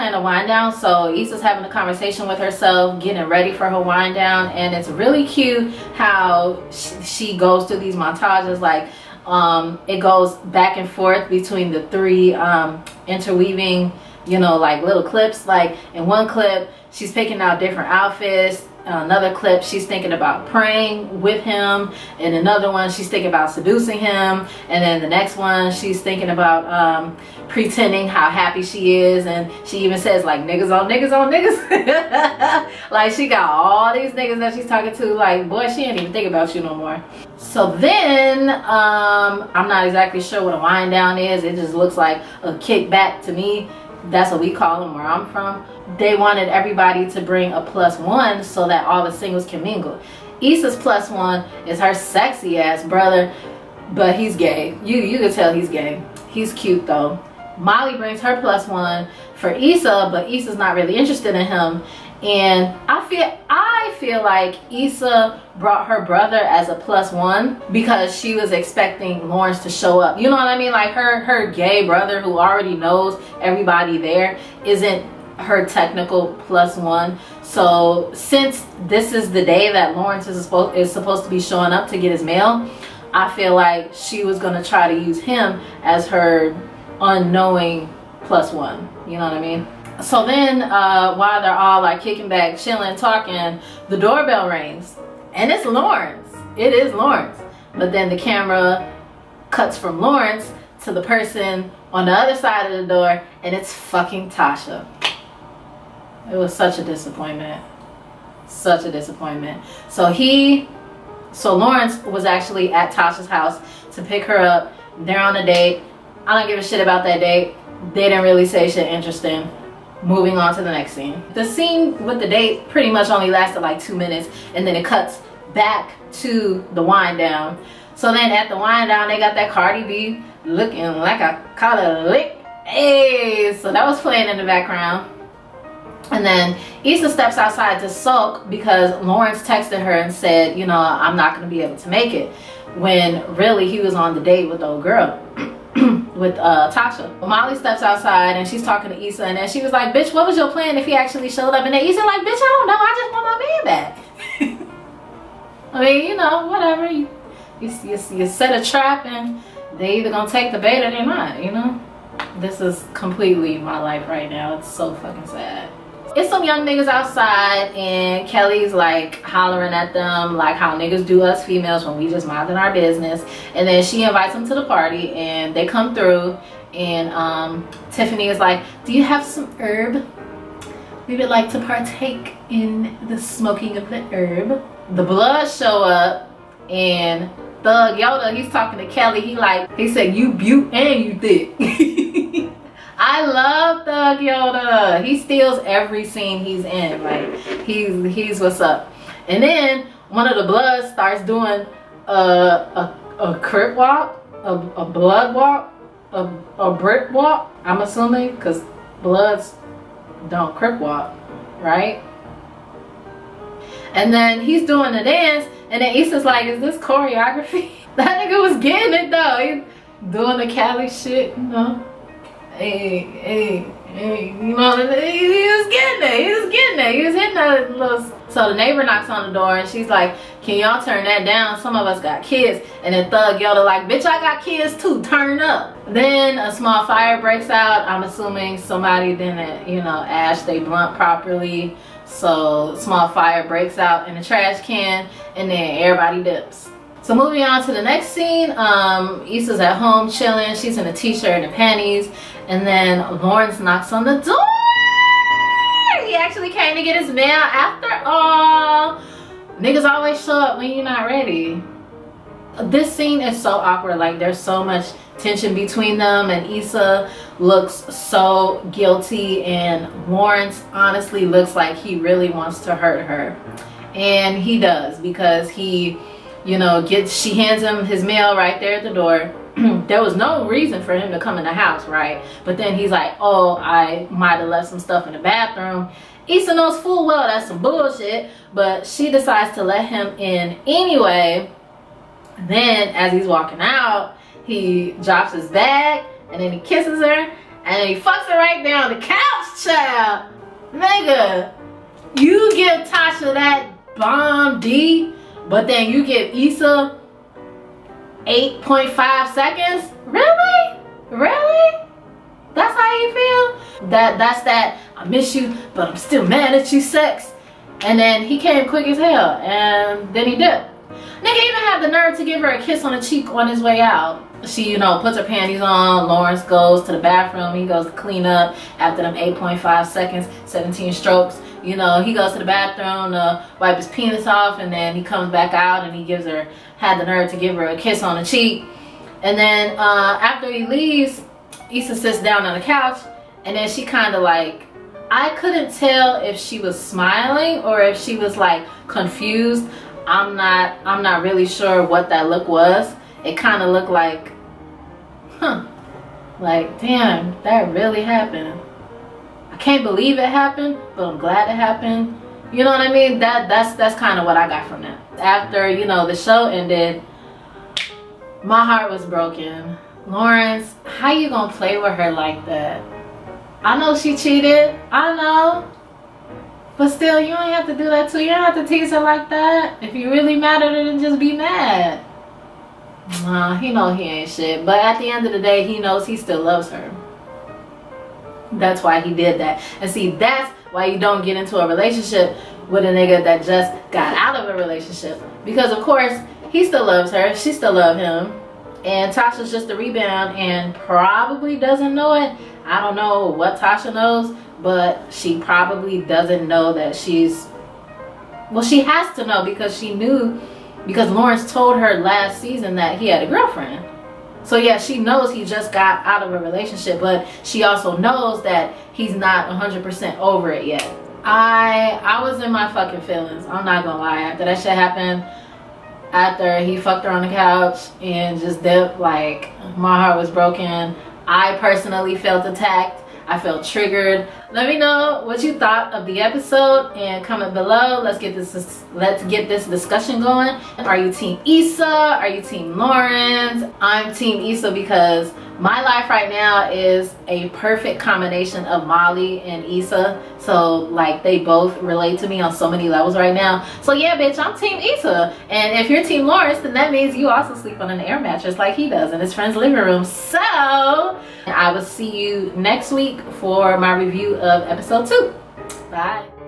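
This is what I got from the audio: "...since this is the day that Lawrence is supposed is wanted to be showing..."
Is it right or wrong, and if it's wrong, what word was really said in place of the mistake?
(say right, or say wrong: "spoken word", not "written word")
wrong: "supposed", not "wanted".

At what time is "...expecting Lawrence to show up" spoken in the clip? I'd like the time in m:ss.
1:08.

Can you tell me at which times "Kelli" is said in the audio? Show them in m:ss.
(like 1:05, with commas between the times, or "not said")
2:48, 3:08.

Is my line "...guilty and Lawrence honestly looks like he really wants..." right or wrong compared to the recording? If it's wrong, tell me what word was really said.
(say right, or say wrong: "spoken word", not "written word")
right.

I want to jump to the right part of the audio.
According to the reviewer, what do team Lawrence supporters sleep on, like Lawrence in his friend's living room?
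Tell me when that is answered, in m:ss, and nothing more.
7:38.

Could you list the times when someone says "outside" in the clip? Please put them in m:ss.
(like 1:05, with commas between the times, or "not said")
2:17, 2:27, 2:46.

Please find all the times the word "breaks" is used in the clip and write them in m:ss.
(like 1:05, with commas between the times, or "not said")
3:57, 4:03.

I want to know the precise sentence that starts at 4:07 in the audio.
So moving on to the next scene, um, Issa's at home chilling.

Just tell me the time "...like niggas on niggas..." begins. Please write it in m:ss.
0:30.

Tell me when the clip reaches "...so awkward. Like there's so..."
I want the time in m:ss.
4:23.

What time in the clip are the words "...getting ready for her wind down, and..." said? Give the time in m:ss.
0:03.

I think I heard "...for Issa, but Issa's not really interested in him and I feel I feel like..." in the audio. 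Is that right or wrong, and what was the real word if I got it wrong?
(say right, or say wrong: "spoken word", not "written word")
right.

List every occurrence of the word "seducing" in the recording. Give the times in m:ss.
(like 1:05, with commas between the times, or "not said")
0:23.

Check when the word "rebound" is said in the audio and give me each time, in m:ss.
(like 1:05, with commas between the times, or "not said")
6:39.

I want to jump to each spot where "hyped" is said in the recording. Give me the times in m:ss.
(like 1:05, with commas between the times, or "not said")
not said.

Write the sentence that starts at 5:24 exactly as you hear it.
She, you know, puts her panties on.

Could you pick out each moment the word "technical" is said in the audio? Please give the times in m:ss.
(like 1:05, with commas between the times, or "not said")
1:15.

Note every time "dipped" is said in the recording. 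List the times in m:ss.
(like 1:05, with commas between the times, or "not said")
7:08.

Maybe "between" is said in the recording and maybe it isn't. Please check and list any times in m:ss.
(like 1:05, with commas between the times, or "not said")
0:11, 4:25.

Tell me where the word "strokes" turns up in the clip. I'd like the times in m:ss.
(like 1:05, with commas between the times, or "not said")
5:30.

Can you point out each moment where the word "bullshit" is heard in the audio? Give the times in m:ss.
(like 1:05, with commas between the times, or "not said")
4:47.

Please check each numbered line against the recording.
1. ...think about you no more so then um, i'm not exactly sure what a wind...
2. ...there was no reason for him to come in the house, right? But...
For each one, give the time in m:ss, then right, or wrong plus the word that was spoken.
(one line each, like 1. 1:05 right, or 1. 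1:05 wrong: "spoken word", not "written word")
1. 0:36 right
2. 4:39 right.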